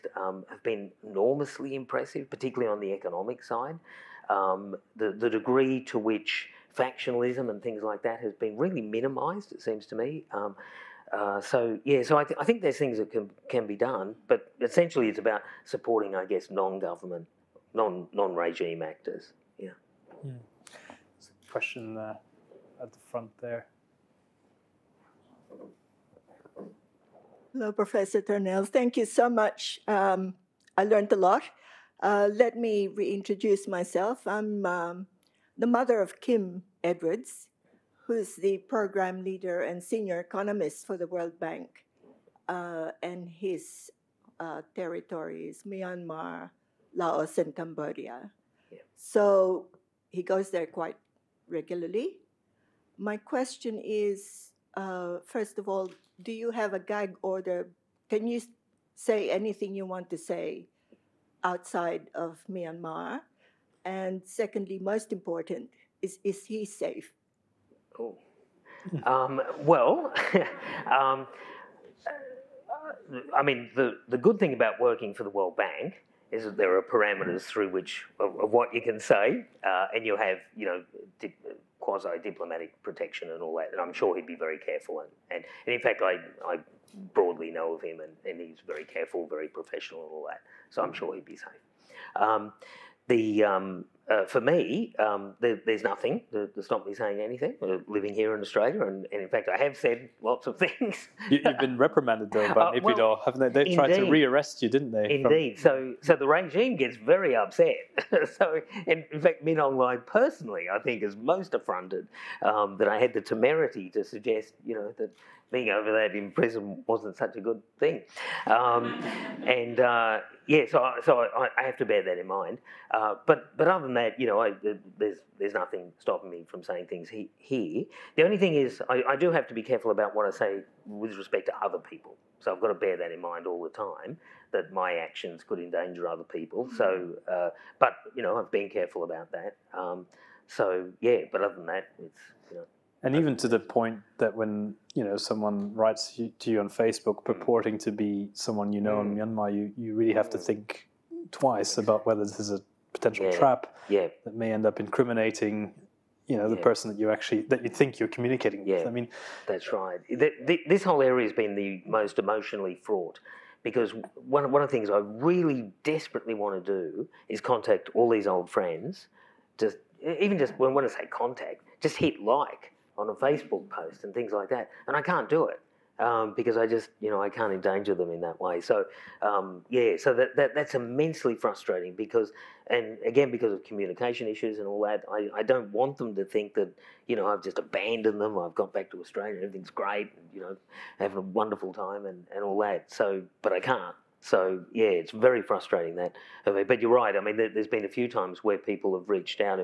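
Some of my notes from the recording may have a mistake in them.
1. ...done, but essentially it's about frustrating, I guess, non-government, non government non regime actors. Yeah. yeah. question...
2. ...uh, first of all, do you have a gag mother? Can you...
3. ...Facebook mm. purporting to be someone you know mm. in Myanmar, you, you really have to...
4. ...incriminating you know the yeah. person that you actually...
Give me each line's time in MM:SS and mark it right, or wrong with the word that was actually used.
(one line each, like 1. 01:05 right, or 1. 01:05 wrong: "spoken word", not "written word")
1. 00:13 wrong: "supporting", not "frustrating"
2. 00:54 wrong: "order", not "mother"
3. 02:26 right
4. 02:34 right.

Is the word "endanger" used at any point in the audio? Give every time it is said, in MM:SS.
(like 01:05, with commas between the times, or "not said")
02:15, 02:57.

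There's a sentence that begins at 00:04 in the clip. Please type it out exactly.
Um, the the degree to which factionalism and things like that has been really minimised, it seems to me.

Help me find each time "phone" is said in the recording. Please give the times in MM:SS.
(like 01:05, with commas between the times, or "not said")
not said.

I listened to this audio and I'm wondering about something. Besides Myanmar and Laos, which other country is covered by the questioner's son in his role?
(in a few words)
Cambodia.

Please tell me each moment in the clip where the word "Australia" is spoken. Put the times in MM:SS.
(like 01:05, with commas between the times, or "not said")
01:38, 03:09.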